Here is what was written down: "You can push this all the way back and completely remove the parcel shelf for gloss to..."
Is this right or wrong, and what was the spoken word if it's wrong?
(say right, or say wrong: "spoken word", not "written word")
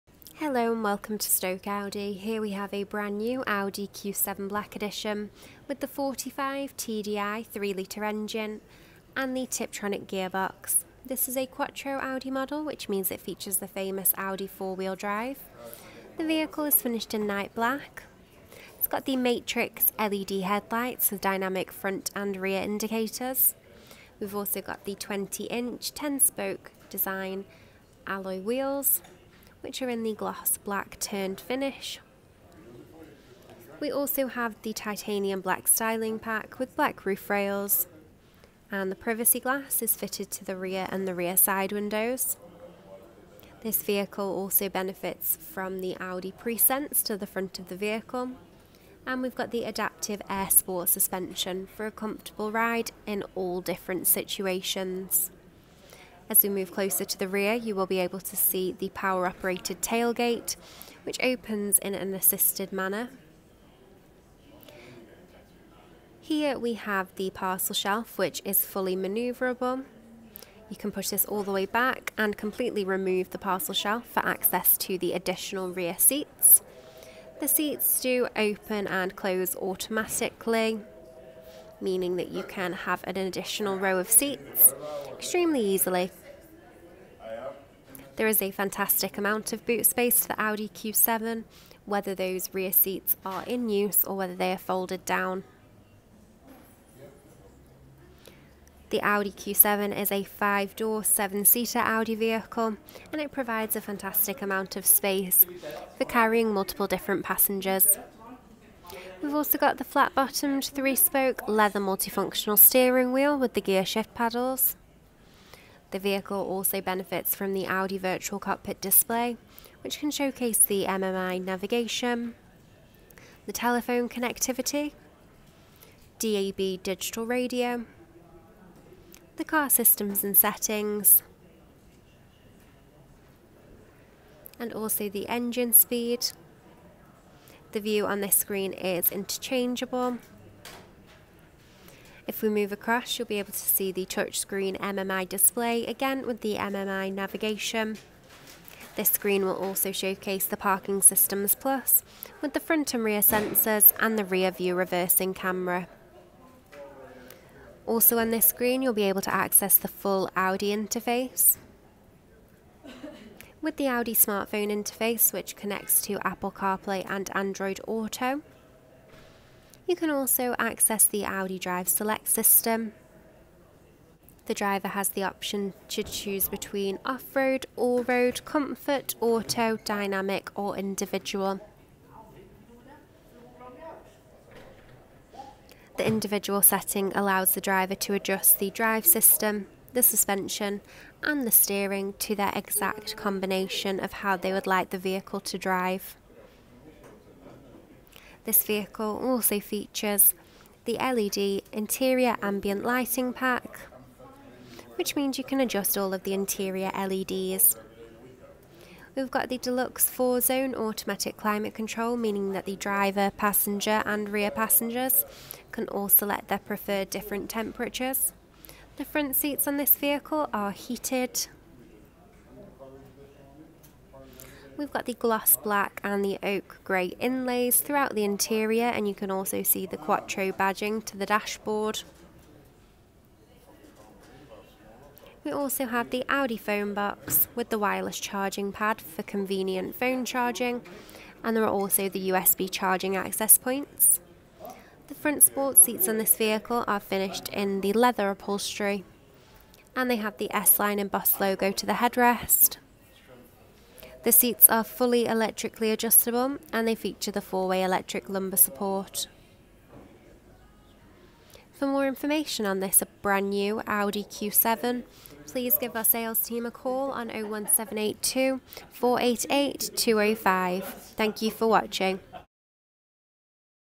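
wrong: "access", not "gloss".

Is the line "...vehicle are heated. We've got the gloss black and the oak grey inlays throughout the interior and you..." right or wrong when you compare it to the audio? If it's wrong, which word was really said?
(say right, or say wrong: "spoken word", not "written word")
right.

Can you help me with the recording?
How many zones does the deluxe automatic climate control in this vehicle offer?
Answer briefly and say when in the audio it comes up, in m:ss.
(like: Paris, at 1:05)
4, at 3:30.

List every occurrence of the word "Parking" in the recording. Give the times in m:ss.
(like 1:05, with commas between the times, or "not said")
2:30.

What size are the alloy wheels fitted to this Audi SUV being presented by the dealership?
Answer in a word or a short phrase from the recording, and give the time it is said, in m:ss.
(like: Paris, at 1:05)
20 inch, at 0:24.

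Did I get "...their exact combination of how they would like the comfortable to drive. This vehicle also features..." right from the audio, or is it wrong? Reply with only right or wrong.
wrong.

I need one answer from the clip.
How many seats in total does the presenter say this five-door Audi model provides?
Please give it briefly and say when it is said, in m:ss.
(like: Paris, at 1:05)
7, at 1:41.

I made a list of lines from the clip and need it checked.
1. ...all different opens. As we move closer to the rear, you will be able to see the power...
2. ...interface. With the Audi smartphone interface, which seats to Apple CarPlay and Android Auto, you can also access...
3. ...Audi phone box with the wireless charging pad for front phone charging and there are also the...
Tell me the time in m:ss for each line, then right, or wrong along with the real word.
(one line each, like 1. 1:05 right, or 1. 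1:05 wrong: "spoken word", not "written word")
1. 0:53 wrong: "situations", not "opens"
2. 2:40 wrong: "connects", not "seats"
3. 3:56 wrong: "convenient", not "front".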